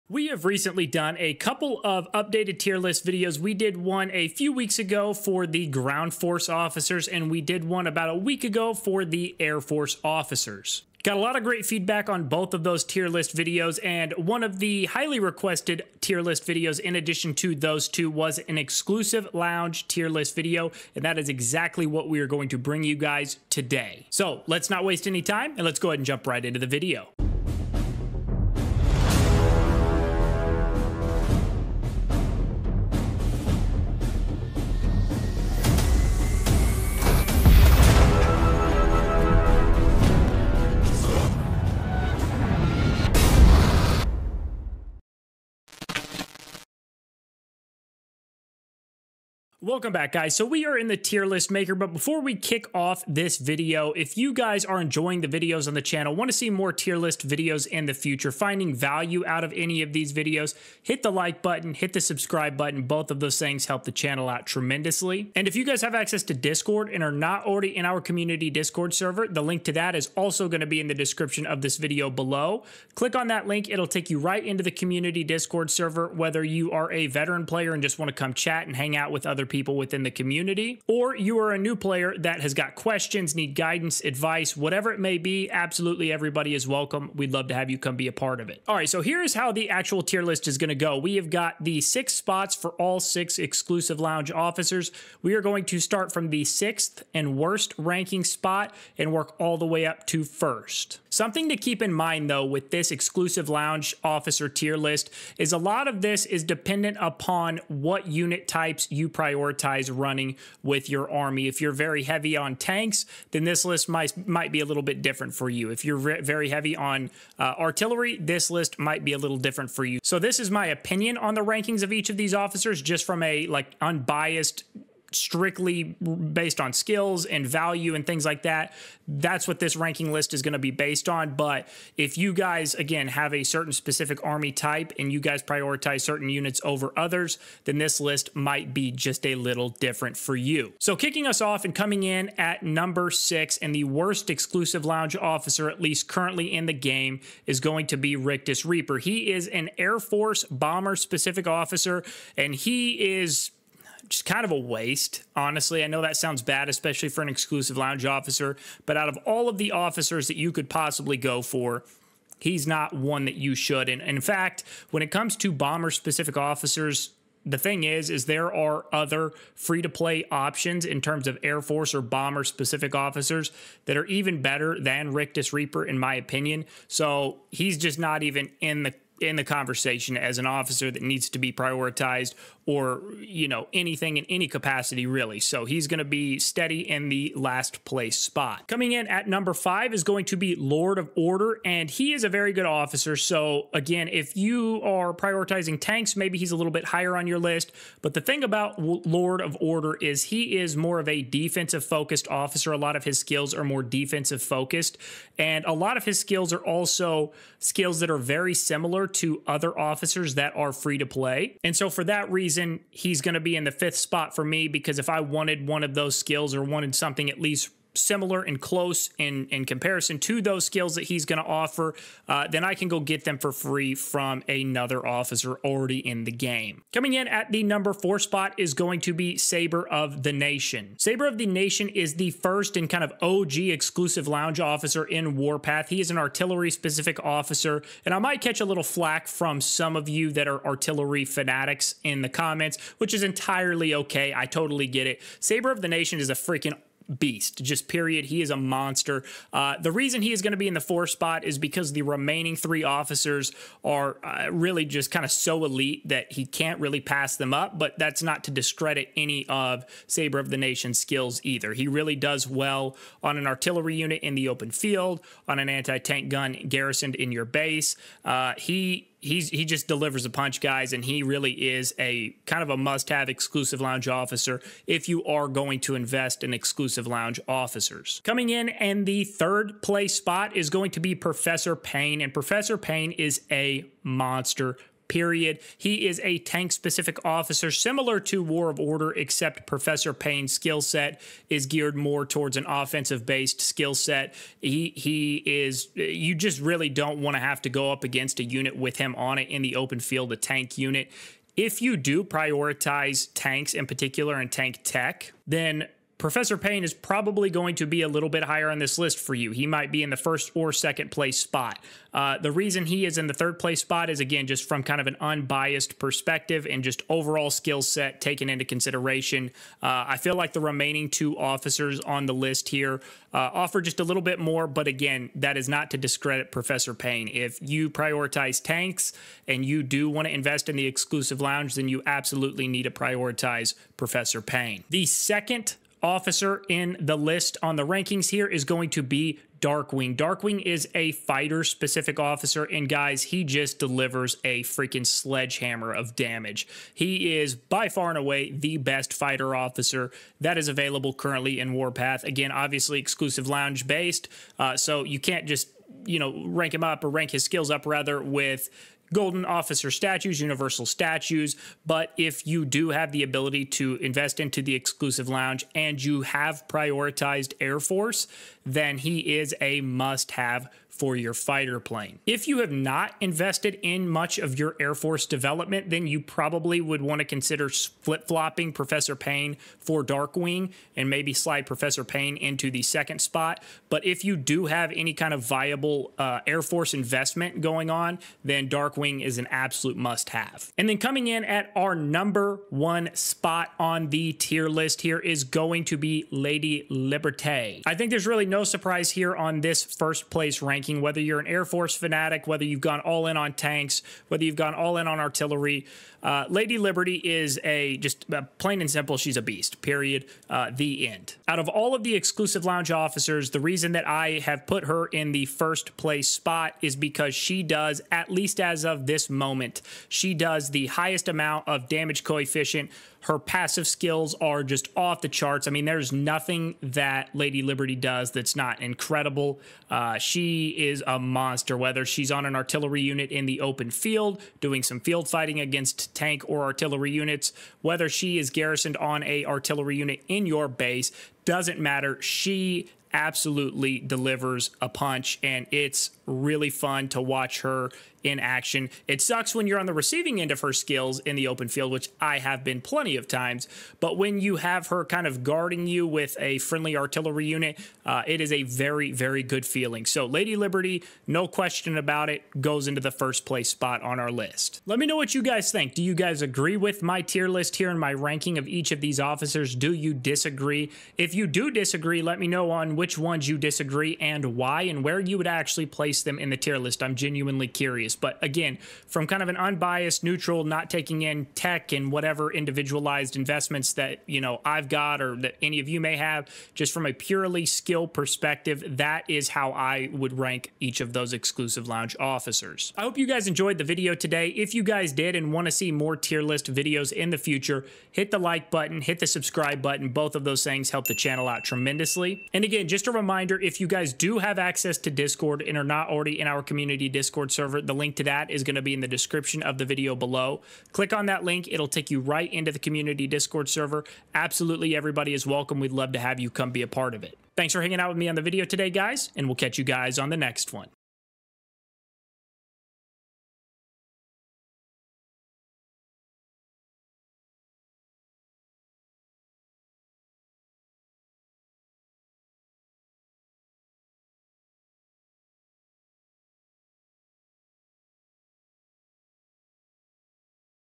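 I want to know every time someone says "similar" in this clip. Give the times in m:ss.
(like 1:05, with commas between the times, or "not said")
3:28, 3:37, 4:47.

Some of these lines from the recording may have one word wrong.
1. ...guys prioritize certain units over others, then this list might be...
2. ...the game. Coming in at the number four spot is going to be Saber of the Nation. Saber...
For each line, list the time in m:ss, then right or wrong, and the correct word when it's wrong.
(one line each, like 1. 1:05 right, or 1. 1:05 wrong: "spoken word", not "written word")
1. 2:15 right
2. 3:46 right.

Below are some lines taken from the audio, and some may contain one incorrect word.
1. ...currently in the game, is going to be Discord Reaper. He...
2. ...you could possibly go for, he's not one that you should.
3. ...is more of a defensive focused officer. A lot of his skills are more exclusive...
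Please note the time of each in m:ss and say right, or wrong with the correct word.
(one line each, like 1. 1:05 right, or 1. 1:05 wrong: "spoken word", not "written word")
1. 2:26 wrong: "Rictus", not "Discord"
2. 2:40 right
3. 3:20 wrong: "defensive", not "exclusive".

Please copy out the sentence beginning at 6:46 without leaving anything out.
Uh, Lady Liberty is a just uh, plain and simple, she's a beast, period.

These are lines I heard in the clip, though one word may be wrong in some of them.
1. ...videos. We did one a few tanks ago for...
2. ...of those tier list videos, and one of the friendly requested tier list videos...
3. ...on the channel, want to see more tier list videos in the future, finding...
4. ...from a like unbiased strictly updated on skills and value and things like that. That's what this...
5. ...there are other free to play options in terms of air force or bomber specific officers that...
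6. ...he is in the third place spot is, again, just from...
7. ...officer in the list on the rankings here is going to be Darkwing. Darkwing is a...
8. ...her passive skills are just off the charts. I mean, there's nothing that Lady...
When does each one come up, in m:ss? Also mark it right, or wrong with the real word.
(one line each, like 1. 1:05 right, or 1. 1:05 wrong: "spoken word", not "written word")
1. 0:03 wrong: "weeks", not "tanks"
2. 0:12 wrong: "highly", not "friendly"
3. 0:55 right
4. 2:03 wrong: "based", not "updated"
5. 2:48 right
6. 5:12 right
7. 5:36 right
8. 7:03 right.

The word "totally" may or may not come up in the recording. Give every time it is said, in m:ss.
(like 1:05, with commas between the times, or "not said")
4:04.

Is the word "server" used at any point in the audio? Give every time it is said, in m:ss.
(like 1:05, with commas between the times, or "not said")
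1:08, 1:15, 8:27, 8:33.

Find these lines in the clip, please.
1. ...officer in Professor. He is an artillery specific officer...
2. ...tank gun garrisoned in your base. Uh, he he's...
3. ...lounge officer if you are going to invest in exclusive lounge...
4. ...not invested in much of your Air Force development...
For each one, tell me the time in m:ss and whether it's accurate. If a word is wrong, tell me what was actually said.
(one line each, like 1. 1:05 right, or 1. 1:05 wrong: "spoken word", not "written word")
1. 3:54 wrong: "Warpath", not "Professor"
2. 4:25 right
3. 4:33 right
4. 6:12 right.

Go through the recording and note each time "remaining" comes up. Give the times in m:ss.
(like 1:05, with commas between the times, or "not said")
4:12, 5:20.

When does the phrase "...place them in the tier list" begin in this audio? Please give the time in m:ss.
7:55.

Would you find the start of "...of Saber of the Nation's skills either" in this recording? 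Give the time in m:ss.
4:19.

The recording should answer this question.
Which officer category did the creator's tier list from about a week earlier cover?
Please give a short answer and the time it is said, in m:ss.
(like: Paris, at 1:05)
Air force officers, at 0:09.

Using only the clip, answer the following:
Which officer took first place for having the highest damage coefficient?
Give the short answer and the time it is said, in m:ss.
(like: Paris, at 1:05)
Lady Liberté, at 6:36.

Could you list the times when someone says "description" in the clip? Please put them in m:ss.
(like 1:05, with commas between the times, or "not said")
1:10, 8:29.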